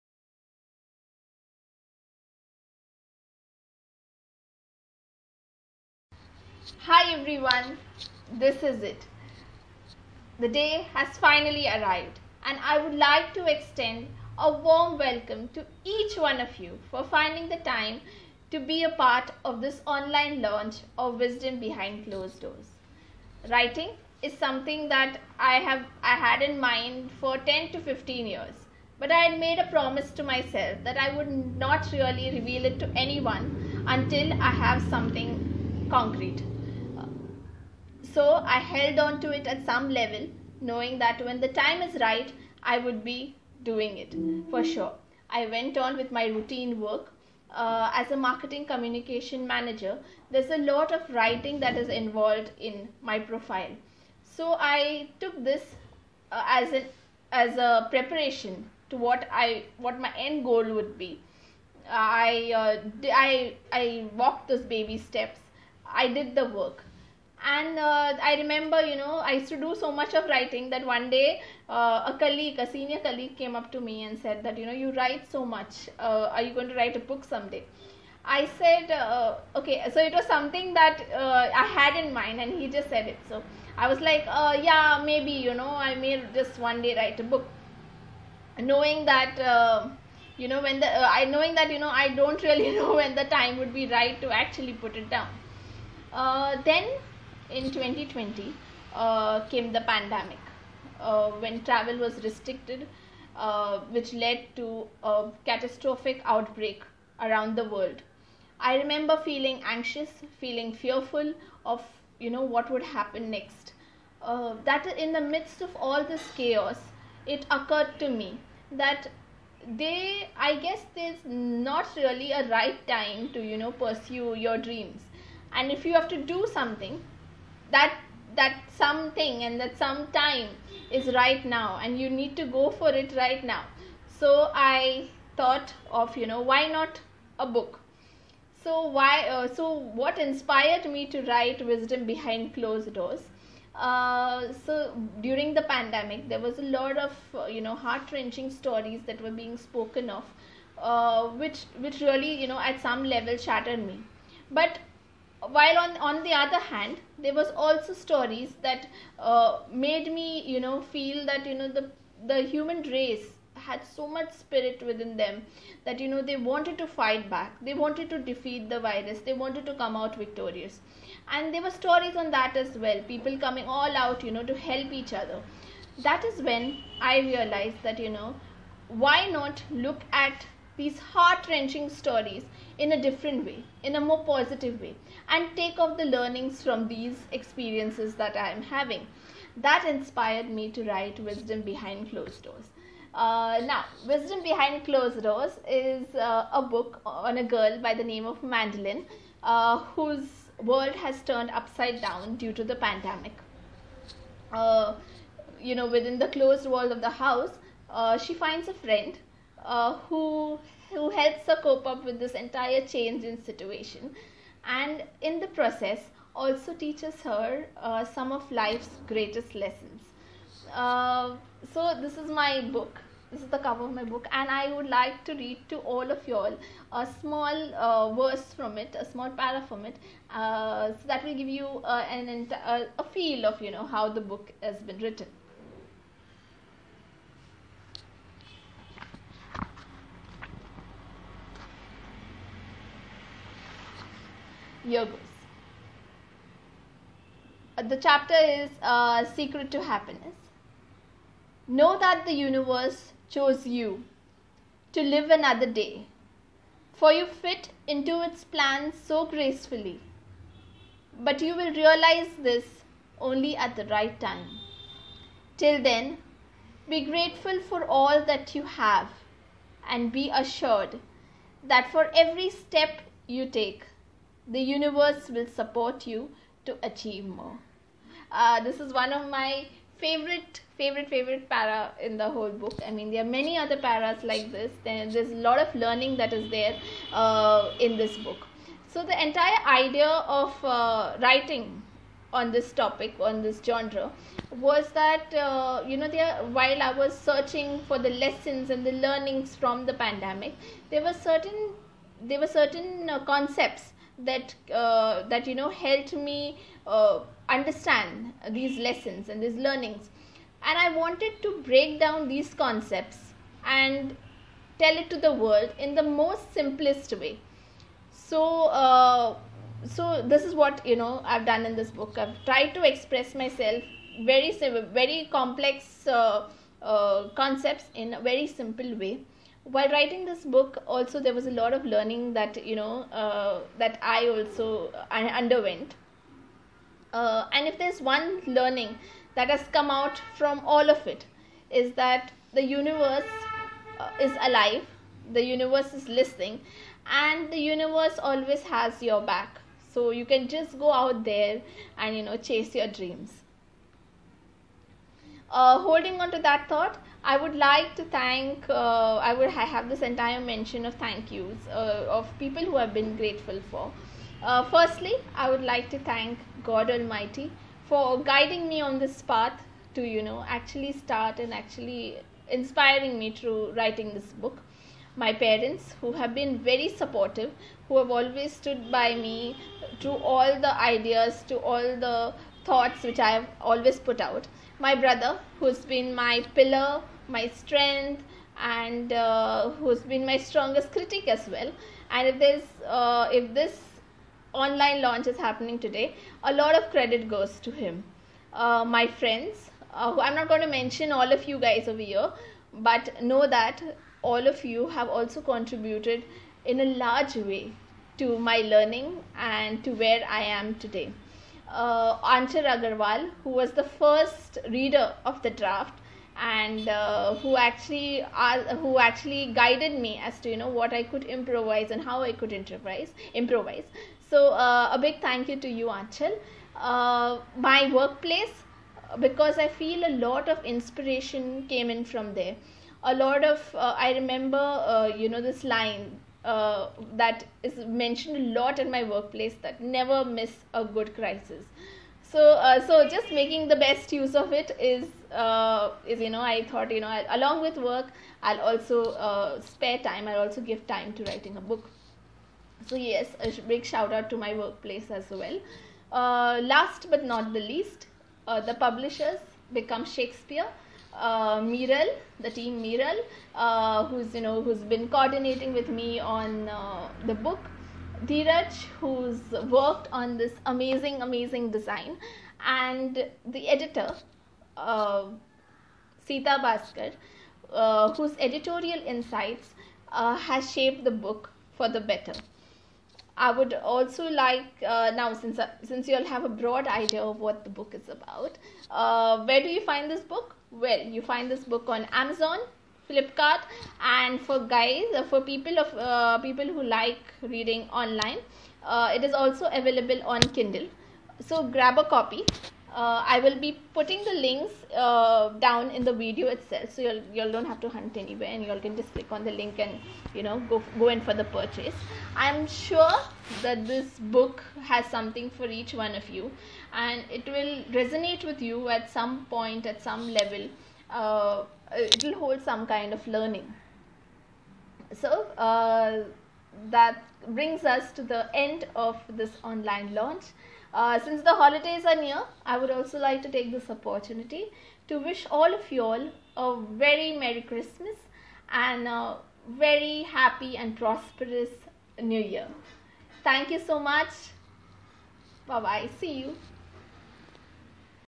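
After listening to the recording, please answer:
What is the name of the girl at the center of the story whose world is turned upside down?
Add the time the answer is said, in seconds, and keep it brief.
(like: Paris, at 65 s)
Mandolin, at 198 s.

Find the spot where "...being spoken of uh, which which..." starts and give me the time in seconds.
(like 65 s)
149 s.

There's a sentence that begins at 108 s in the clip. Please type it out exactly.
I remember feeling anxious, feeling fearful of you know what would happen next.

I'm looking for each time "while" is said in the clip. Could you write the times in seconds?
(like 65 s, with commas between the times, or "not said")
155 s, 296 s, 329 s.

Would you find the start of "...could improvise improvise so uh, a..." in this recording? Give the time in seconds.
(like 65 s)
422 s.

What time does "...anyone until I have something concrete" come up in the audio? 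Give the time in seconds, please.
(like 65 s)
32 s.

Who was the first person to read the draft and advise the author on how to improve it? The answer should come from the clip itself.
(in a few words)
Achal Agarwal.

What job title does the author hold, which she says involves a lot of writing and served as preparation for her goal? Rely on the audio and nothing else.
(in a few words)
Marketing communication manager.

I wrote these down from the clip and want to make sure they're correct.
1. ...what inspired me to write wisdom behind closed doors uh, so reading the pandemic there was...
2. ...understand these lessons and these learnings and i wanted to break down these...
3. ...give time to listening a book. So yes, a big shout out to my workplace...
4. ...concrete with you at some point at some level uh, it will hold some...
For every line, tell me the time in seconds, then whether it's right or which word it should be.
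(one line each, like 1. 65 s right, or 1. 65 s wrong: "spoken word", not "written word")
1. 140 s wrong: "during", not "reading"
2. 307 s right
3. 450 s wrong: "writing", not "listening"
4. 517 s wrong: "resonate", not "concrete".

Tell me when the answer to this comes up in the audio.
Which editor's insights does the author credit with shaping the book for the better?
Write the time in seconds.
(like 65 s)
476 s.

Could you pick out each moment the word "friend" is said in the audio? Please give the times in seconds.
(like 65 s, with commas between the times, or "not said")
208 s, 399 s.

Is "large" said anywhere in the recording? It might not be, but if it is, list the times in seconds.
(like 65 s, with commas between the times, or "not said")
407 s.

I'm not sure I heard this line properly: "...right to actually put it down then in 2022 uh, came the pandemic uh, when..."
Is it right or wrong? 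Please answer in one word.
wrong.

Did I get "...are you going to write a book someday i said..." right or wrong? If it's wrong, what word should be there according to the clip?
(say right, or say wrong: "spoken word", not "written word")
right.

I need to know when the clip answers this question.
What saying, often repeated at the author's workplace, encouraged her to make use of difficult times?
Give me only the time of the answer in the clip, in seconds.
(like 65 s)
439 s.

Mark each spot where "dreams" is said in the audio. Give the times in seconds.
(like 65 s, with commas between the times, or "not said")
124 s, 352 s.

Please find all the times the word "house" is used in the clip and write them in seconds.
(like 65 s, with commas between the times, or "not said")
207 s.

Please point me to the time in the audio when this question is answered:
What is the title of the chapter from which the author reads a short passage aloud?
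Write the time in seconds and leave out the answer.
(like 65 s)
249 s.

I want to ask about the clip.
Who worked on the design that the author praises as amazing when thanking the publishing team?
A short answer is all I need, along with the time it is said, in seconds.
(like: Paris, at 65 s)
Dheeraj, at 468 s.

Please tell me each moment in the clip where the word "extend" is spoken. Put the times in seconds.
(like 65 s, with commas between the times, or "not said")
13 s.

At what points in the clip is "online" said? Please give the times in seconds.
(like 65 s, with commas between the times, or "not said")
19 s, 394 s, 498 s, 529 s.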